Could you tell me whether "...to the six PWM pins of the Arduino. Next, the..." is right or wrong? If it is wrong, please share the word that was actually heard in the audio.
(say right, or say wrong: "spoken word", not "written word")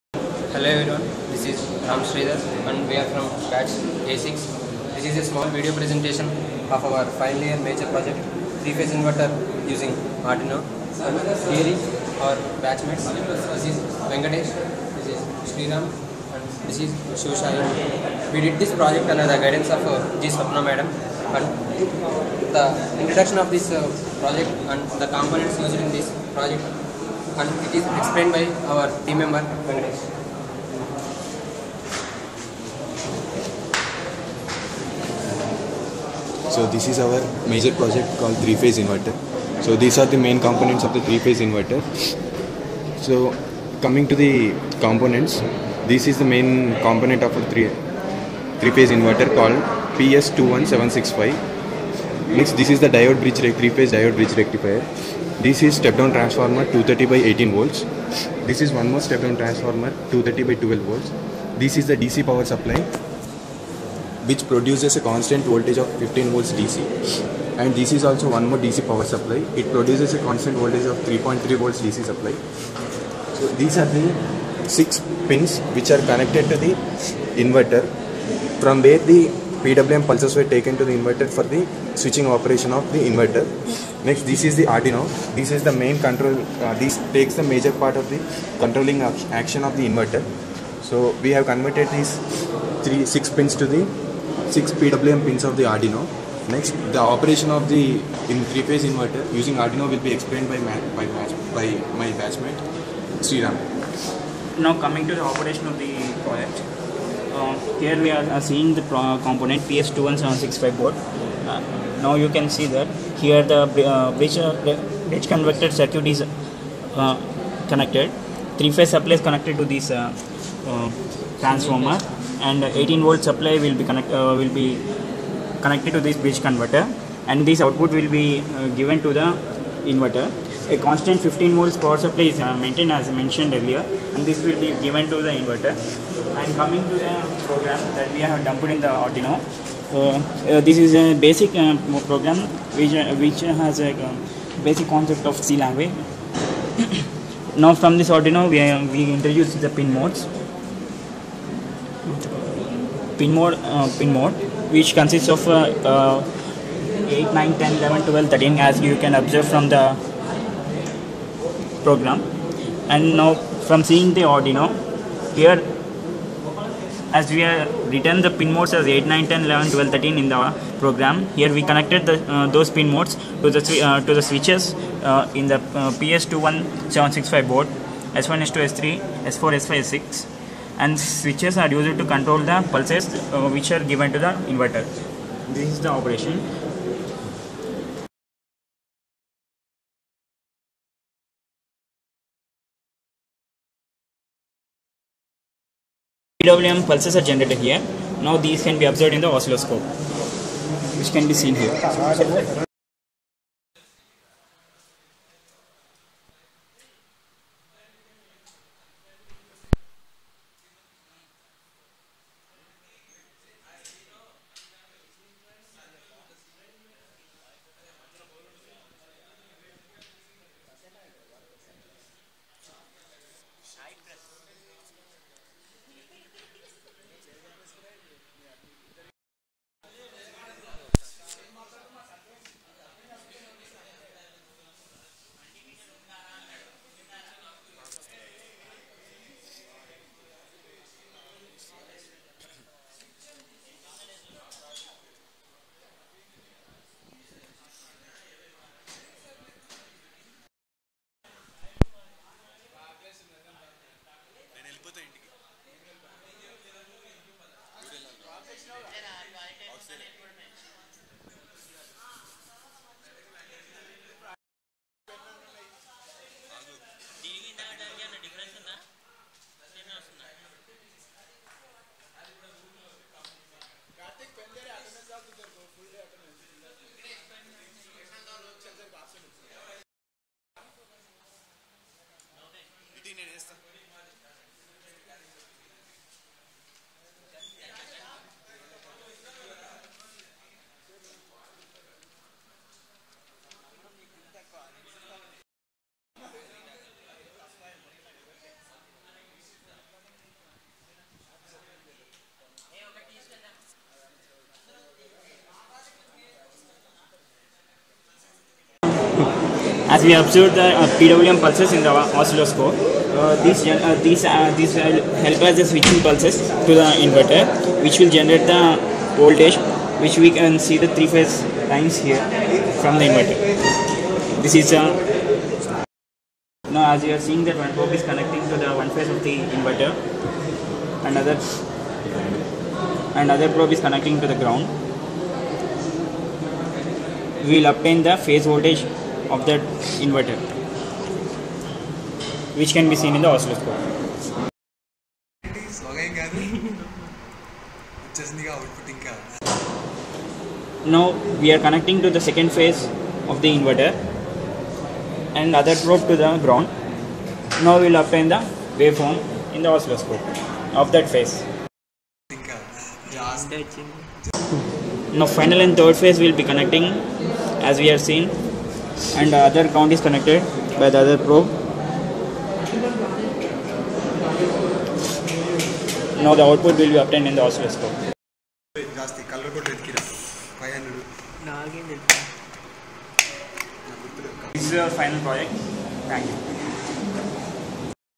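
right.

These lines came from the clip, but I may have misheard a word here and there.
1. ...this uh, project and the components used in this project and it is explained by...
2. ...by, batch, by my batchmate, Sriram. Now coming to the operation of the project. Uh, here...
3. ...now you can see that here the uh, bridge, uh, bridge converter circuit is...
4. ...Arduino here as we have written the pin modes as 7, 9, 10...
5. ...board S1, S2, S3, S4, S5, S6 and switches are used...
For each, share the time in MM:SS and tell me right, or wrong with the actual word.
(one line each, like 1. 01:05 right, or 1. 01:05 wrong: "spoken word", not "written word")
1. 00:23 right
2. 01:40 right
3. 01:52 right
4. 02:44 wrong: "8", not "7"
5. 02:57 right.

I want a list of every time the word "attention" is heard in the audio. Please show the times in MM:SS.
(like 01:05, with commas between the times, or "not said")
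not said.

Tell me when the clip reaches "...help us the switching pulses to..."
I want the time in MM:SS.
05:15.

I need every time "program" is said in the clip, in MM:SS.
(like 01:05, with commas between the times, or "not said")
02:17, 02:22, 02:41, 02:50.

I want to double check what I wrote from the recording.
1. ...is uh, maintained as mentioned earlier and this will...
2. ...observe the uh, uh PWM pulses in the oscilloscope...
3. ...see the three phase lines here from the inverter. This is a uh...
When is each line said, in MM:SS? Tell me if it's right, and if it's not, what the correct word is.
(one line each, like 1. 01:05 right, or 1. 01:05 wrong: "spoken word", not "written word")
1. 02:12 right
2. 05:10 right
3. 05:20 right.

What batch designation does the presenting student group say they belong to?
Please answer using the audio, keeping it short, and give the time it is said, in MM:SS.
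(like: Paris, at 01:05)
A6, at 00:04.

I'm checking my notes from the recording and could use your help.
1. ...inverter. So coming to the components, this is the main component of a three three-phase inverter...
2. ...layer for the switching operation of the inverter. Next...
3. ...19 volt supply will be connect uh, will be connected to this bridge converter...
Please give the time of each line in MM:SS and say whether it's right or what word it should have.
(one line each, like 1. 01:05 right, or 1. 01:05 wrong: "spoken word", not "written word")
1. 00:41 right
2. 01:20 wrong: "inverter", not "layer"
3. 02:02 wrong: "18", not "19".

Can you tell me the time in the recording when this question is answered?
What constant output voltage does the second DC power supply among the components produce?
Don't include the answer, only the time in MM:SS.
01:10.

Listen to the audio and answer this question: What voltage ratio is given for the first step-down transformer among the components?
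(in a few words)
230 by 18 volts.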